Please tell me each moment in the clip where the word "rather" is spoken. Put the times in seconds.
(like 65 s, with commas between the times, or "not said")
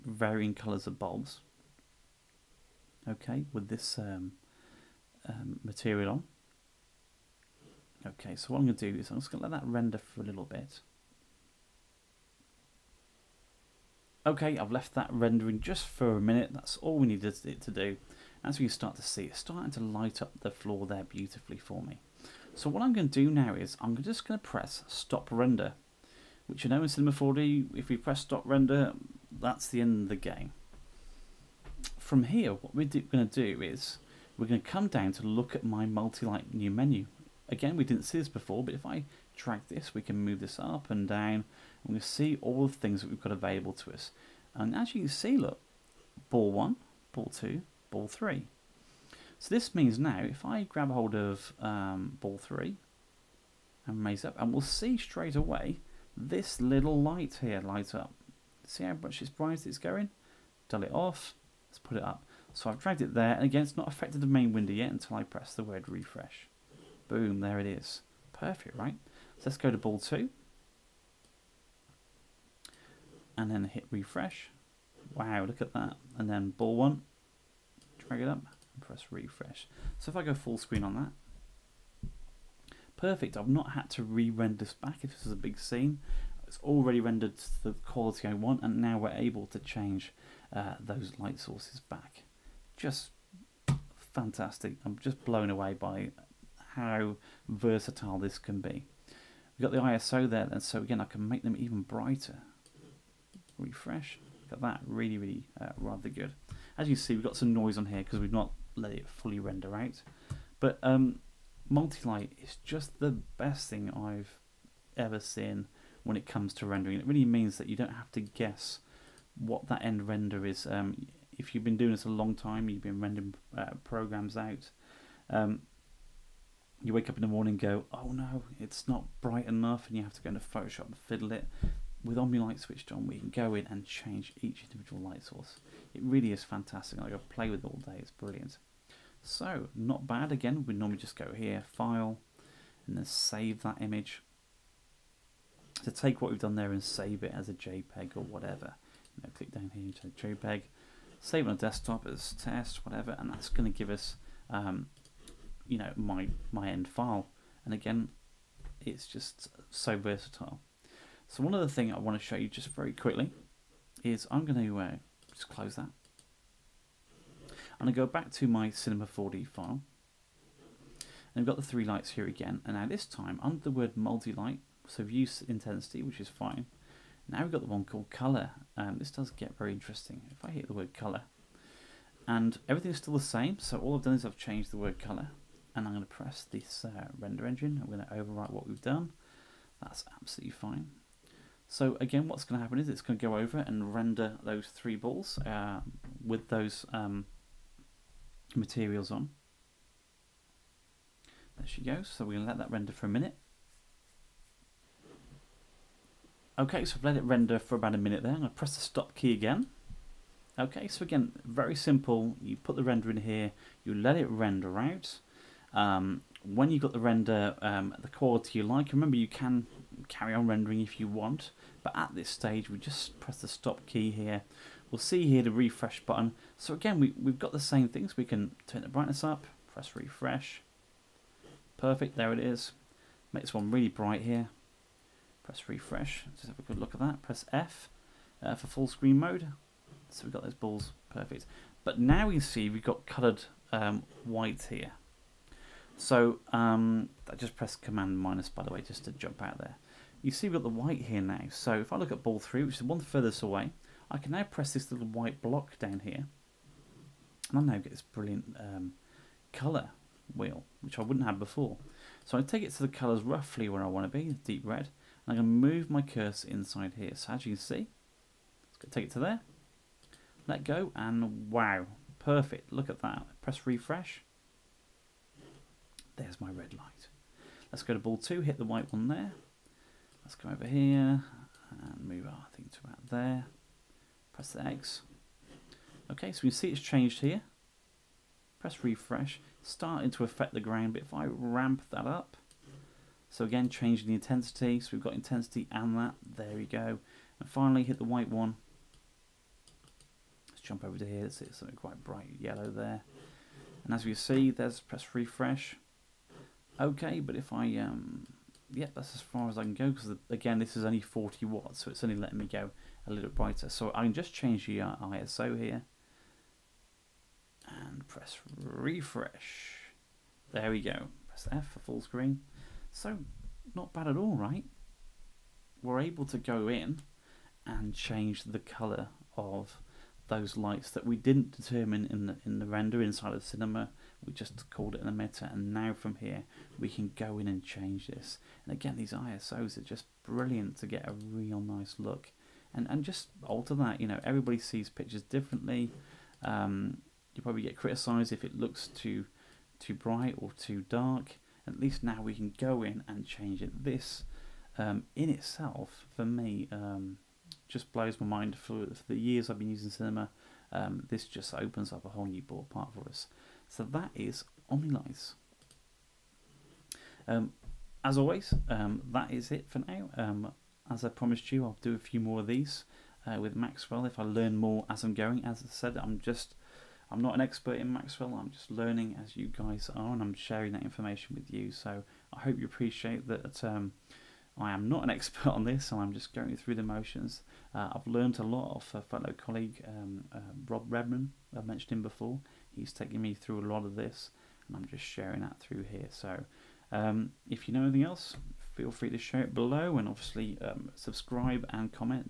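105 s.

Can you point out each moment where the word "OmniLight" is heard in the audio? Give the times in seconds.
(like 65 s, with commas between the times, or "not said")
132 s, 364 s.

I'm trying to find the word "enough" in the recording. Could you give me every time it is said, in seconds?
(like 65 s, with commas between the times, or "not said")
129 s.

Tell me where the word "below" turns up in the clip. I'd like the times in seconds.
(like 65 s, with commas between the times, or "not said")
399 s.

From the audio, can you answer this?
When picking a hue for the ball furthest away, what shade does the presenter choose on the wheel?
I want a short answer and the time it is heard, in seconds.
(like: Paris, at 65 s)
deep red, at 264 s.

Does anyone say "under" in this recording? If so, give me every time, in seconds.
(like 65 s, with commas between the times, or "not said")
173 s.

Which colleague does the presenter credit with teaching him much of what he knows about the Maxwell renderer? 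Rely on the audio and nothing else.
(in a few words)
Rob Redman.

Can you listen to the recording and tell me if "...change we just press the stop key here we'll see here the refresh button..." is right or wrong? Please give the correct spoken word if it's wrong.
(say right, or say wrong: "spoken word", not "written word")
wrong: "stage", not "change".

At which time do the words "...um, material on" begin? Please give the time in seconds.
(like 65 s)
5 s.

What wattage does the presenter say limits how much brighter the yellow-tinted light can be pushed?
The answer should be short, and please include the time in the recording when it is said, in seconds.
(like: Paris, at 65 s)
40 watts, at 311 s.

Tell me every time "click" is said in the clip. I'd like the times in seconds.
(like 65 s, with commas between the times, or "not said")
149 s.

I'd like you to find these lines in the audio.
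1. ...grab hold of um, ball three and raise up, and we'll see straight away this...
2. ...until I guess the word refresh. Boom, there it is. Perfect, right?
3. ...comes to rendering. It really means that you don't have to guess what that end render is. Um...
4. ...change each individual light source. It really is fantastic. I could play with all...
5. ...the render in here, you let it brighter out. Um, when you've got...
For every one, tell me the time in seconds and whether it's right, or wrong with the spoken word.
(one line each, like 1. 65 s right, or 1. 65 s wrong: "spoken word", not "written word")
1. 50 s right
2. 64 s wrong: "press", not "guess"
3. 116 s right
4. 133 s right
5. 212 s wrong: "render", not "brighter".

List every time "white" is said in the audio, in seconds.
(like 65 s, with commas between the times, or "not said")
244 s, 250 s, 255 s, 278 s, 298 s.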